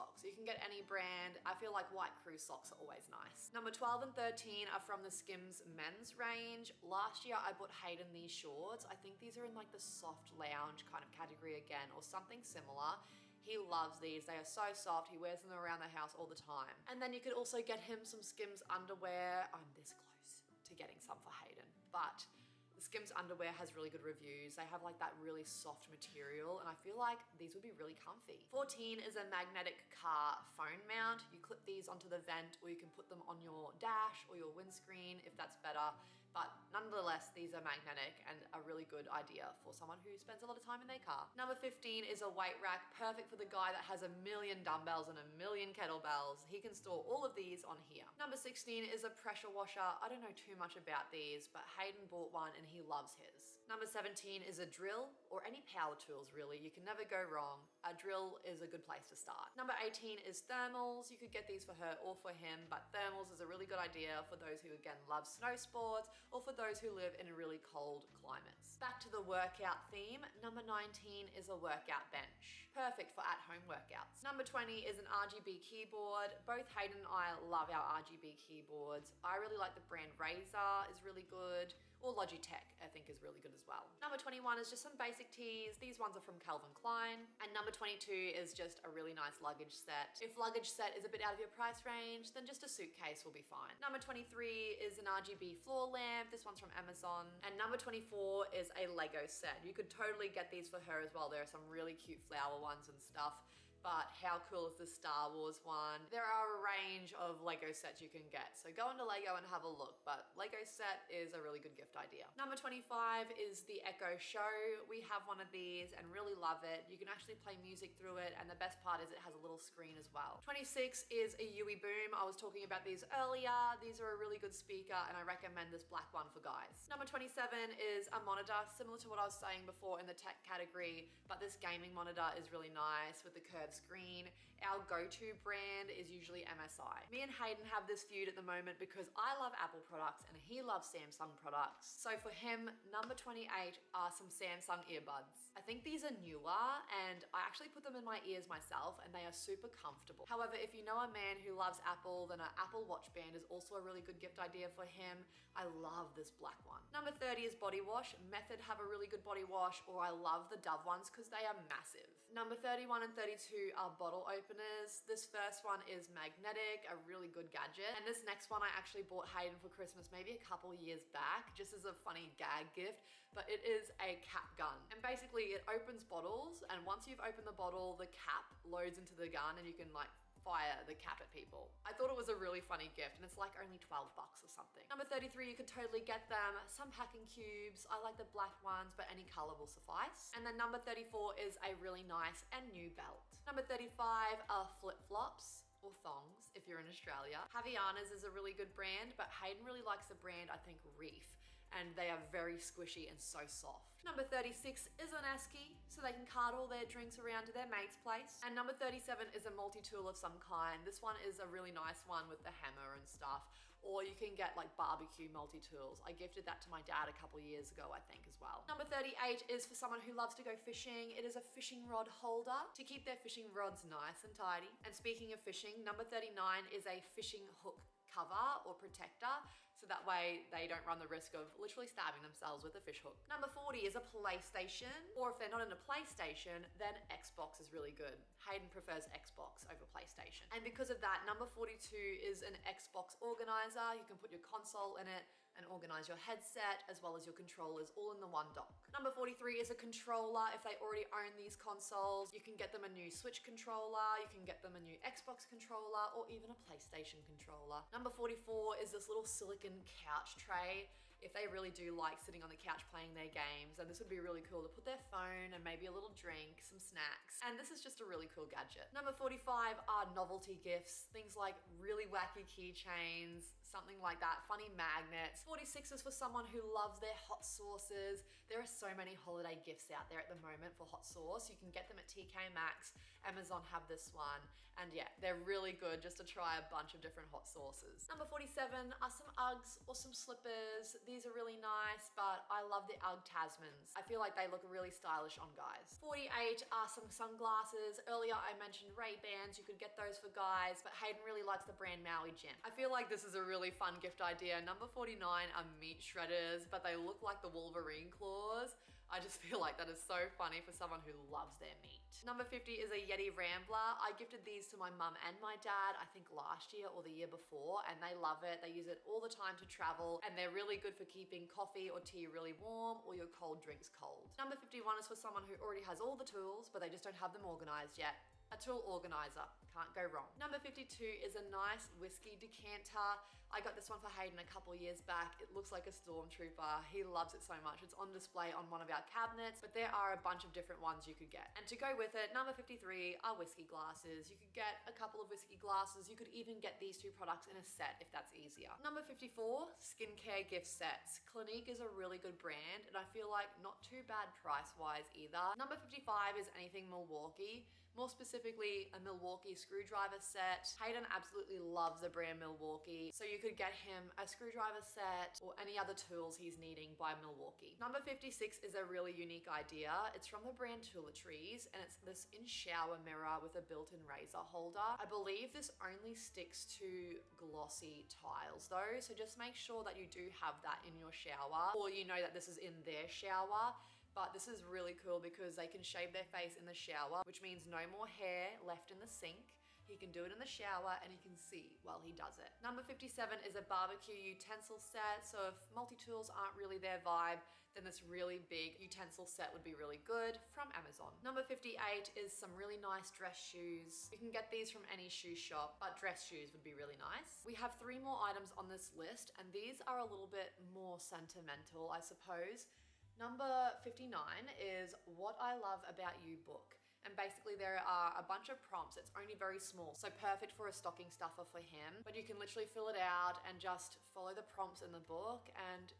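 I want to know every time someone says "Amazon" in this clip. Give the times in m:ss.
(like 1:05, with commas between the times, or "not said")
1:36, 4:43, 6:40.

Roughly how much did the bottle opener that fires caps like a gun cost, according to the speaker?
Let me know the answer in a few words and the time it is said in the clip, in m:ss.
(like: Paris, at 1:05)
12 bucks, at 3:03.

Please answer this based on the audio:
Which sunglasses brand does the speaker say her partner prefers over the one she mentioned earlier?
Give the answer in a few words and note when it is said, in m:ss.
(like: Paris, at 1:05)
Maui Jim, at 5:02.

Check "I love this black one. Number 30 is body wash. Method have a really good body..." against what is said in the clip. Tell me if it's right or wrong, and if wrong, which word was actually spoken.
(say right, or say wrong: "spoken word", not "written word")
right.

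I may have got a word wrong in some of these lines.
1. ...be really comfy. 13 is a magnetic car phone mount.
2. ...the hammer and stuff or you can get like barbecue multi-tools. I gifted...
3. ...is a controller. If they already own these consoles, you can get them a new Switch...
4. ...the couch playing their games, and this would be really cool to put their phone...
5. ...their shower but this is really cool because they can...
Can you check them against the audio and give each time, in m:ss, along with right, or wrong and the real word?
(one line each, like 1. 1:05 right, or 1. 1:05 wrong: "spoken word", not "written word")
1. 0:27 wrong: "14", not "13"
2. 3:32 right
3. 4:09 right
4. 4:22 right
5. 6:22 right.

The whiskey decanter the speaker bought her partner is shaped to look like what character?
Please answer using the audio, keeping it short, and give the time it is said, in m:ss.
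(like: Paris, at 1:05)
a stormtrooper, at 5:35.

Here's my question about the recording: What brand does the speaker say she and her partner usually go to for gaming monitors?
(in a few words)
MSI.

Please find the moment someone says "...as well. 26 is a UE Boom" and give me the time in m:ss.
1:59.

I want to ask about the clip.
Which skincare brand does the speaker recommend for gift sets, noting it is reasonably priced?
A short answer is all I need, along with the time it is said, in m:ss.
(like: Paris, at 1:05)
Clinique, at 5:51.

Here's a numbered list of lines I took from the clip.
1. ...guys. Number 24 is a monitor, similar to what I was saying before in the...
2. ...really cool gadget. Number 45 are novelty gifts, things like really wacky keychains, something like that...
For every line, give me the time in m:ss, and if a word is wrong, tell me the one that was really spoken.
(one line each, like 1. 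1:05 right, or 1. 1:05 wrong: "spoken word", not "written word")
1. 2:06 wrong: "27", not "24"
2. 4:28 right.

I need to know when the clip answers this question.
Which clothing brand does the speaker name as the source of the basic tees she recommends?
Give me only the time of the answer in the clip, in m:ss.
1:26.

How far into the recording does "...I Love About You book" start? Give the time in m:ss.
6:55.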